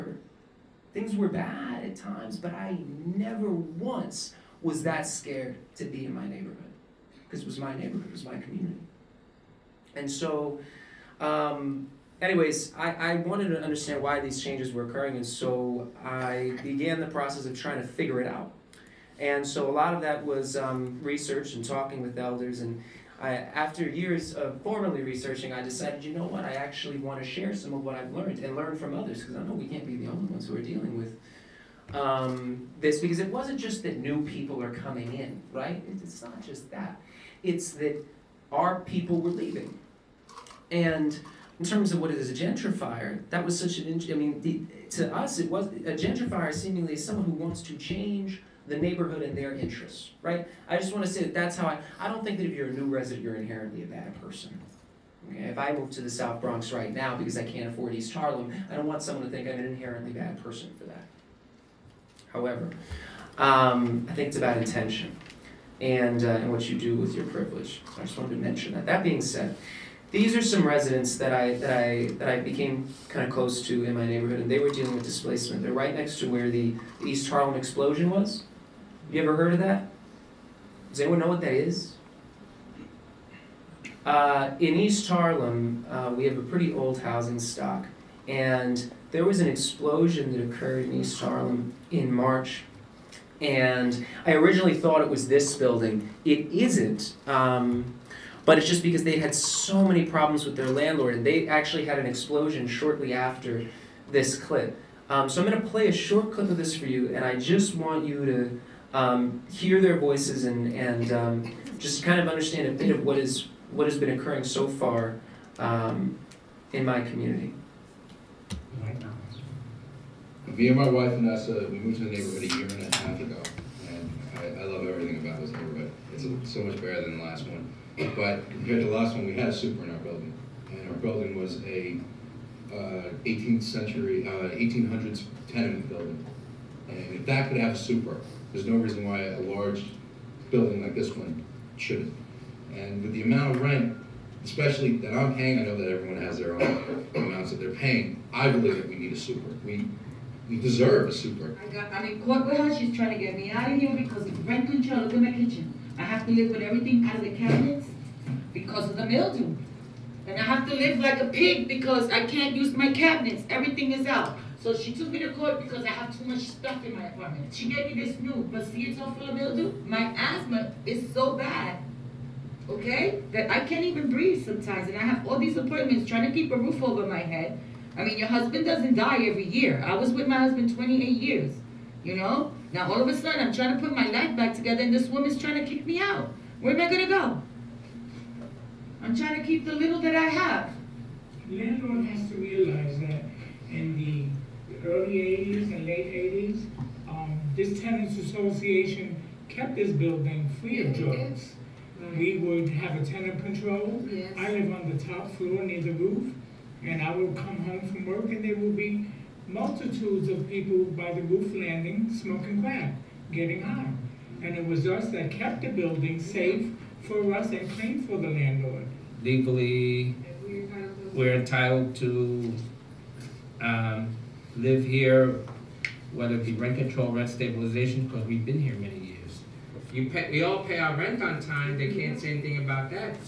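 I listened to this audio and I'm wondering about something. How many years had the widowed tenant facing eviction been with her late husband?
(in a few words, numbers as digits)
28.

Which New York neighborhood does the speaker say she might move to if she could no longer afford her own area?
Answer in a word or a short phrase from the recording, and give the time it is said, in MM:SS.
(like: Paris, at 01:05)
South Bronx, at 00:56.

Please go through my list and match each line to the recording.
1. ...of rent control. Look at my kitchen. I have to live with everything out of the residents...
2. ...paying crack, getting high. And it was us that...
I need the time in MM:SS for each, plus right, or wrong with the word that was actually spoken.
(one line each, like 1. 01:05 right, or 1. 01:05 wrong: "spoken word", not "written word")
1. 02:34 wrong: "cabinets", not "residents"
2. 03:32 wrong: "smoking", not "paying".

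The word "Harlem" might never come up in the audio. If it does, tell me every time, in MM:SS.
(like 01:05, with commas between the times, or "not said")
00:58, 01:17, 01:25, 01:31.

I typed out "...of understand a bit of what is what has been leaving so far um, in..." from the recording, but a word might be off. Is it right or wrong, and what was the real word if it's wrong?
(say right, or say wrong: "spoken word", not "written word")
wrong: "occurring", not "leaving".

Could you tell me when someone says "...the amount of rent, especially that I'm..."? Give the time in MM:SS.
02:23.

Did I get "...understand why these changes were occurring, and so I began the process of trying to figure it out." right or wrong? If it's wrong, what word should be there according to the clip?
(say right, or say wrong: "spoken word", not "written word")
right.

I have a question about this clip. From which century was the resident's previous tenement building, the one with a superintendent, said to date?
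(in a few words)
18th century.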